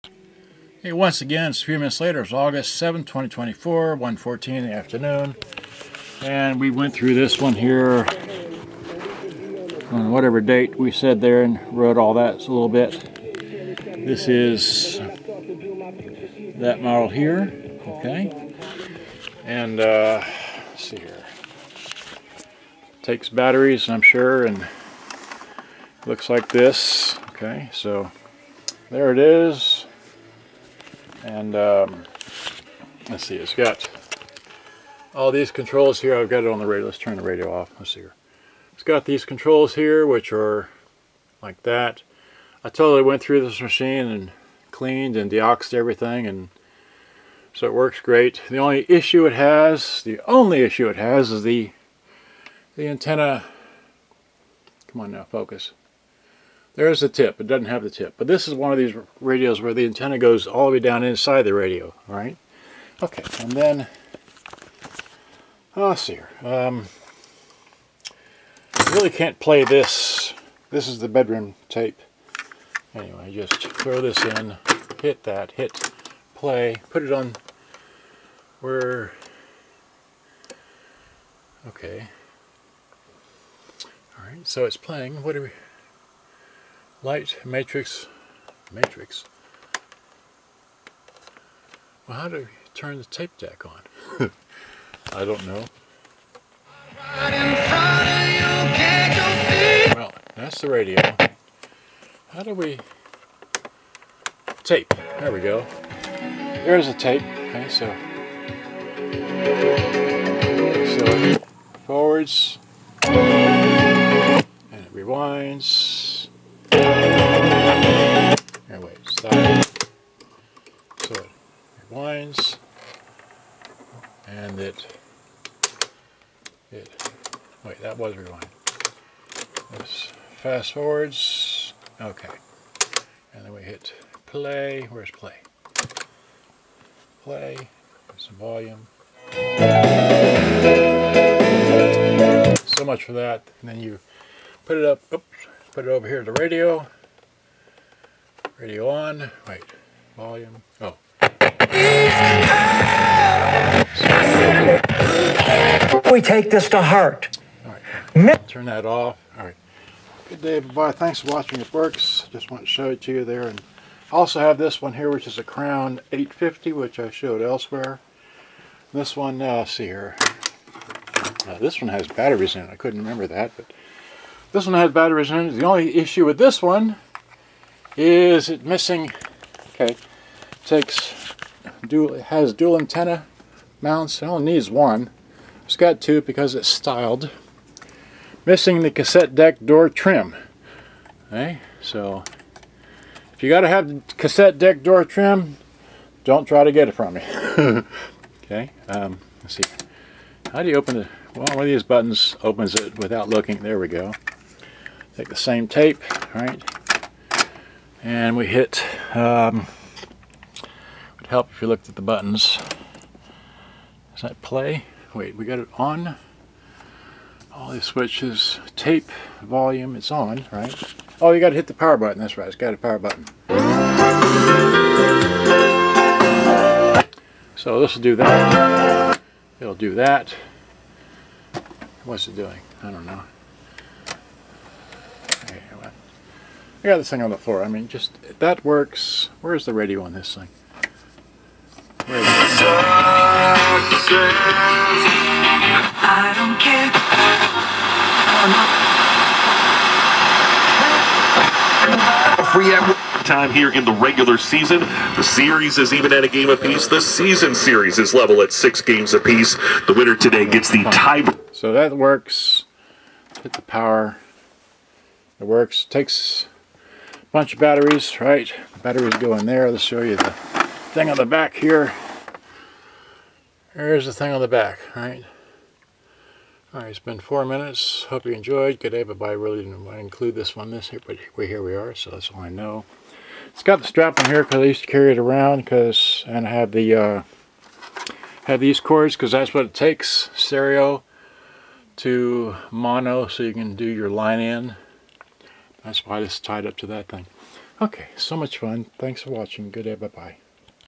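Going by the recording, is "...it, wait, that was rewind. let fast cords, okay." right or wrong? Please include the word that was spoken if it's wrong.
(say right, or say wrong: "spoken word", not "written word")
wrong: "forwards", not "cords".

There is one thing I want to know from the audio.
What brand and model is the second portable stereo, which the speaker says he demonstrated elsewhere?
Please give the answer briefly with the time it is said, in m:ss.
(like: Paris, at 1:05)
Crown 850, at 2:45.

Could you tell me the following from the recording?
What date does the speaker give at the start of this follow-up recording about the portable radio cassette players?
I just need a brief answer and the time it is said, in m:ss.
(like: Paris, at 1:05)
August 7, 2024, at 0:02.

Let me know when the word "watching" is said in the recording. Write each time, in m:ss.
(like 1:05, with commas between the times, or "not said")
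2:41, 4:59.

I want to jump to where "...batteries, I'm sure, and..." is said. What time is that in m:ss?
0:23.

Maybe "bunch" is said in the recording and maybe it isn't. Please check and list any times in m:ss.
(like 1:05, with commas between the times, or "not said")
4:27.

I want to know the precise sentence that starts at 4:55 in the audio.
That's why it's tied up to that thing.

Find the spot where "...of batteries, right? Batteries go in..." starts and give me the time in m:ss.
4:27.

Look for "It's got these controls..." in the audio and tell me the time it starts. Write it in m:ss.
0:38.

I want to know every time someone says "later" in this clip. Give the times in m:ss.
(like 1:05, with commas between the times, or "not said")
0:02.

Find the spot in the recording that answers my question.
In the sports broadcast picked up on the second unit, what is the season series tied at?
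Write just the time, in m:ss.
4:18.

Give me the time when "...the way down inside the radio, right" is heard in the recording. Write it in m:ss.
1:00.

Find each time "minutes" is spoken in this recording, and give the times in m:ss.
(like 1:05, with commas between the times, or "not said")
0:01, 4:37.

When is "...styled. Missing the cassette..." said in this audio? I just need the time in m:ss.
3:06.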